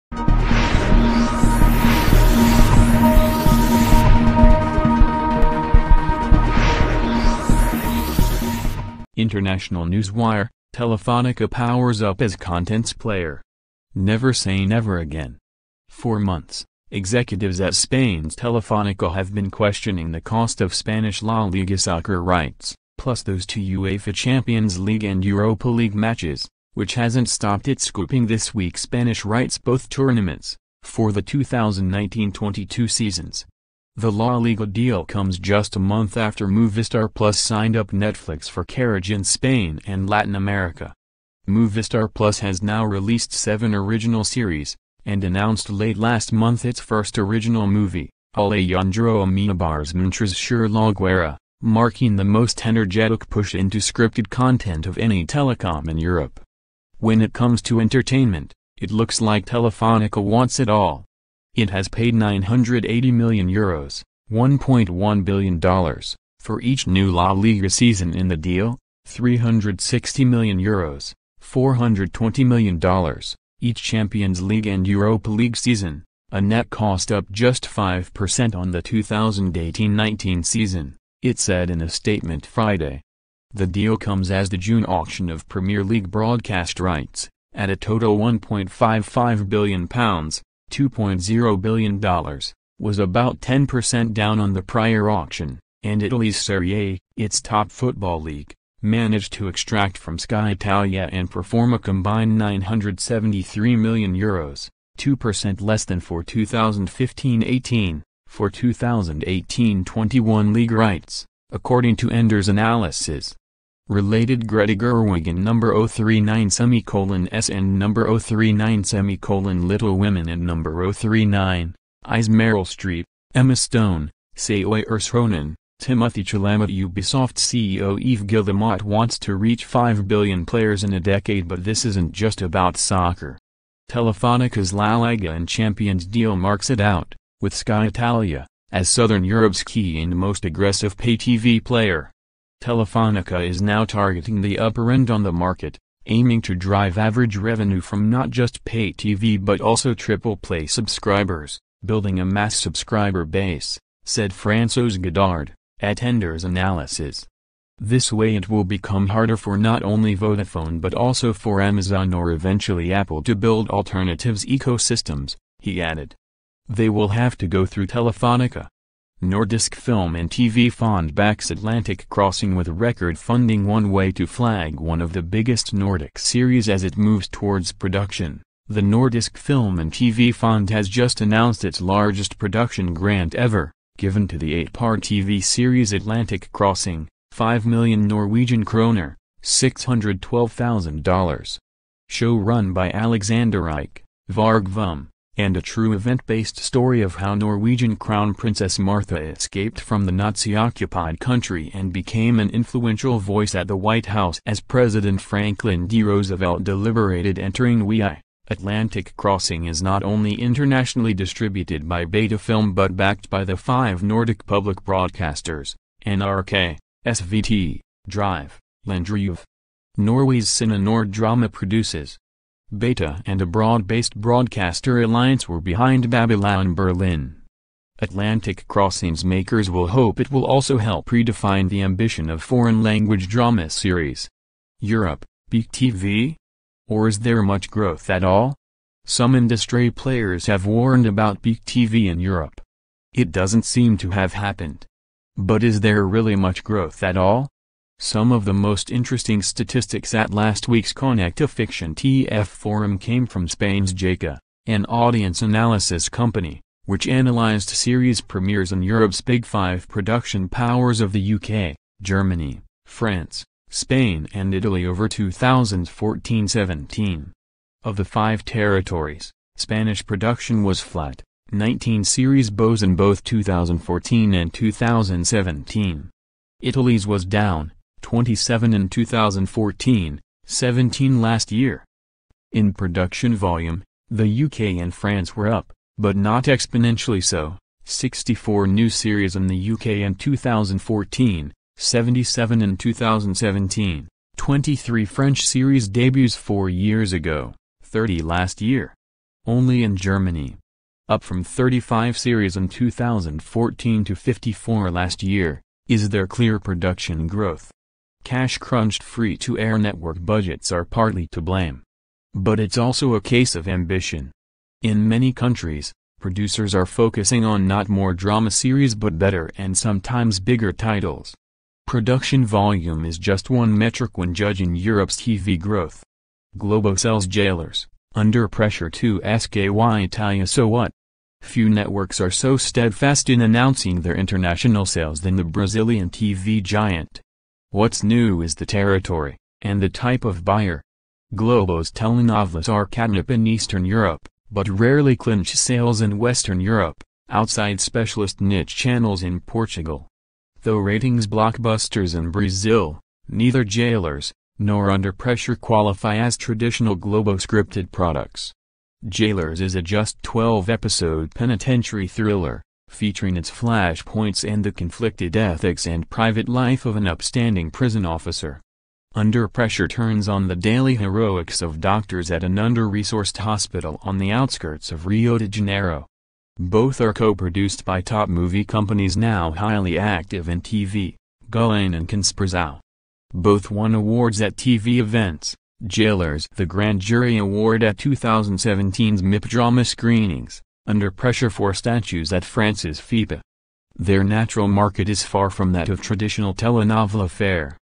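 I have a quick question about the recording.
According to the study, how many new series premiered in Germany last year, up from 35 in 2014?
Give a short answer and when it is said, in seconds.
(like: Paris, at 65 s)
54, at 304 s.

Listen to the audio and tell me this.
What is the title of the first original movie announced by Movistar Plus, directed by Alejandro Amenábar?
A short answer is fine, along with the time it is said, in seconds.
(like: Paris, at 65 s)
Mientras Dure La Guerra, at 49 s.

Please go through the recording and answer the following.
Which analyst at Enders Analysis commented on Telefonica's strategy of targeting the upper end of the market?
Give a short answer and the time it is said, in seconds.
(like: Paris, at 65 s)
François Godard, at 154 s.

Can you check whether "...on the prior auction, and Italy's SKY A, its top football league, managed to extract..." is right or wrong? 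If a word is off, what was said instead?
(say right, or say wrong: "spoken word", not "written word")
wrong: "Serie", not "SKY".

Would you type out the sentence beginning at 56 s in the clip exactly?
When it comes to entertainment, it looks like Telefonica wants it all.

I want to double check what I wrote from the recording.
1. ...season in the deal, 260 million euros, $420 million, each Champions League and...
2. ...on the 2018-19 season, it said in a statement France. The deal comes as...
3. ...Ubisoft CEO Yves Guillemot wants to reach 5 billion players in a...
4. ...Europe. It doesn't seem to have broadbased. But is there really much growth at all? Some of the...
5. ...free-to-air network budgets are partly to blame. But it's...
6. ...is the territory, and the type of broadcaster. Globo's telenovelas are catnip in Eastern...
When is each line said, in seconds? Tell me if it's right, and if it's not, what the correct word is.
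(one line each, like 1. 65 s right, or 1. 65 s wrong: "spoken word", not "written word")
1. 67 s wrong: "360", not "260"
2. 78 s wrong: "Friday", not "France"
3. 126 s right
4. 242 s wrong: "happened", not "broadbased"
5. 309 s right
6. 338 s wrong: "buyer", not "broadcaster".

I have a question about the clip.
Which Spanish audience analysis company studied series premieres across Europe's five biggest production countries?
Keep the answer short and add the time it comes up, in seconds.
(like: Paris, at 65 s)
GECA, at 253 s.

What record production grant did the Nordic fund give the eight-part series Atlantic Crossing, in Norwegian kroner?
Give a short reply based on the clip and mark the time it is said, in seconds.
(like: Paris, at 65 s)
5 million Norwegian kroner, at 187 s.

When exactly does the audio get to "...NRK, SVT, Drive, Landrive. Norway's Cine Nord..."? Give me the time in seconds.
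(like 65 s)
216 s.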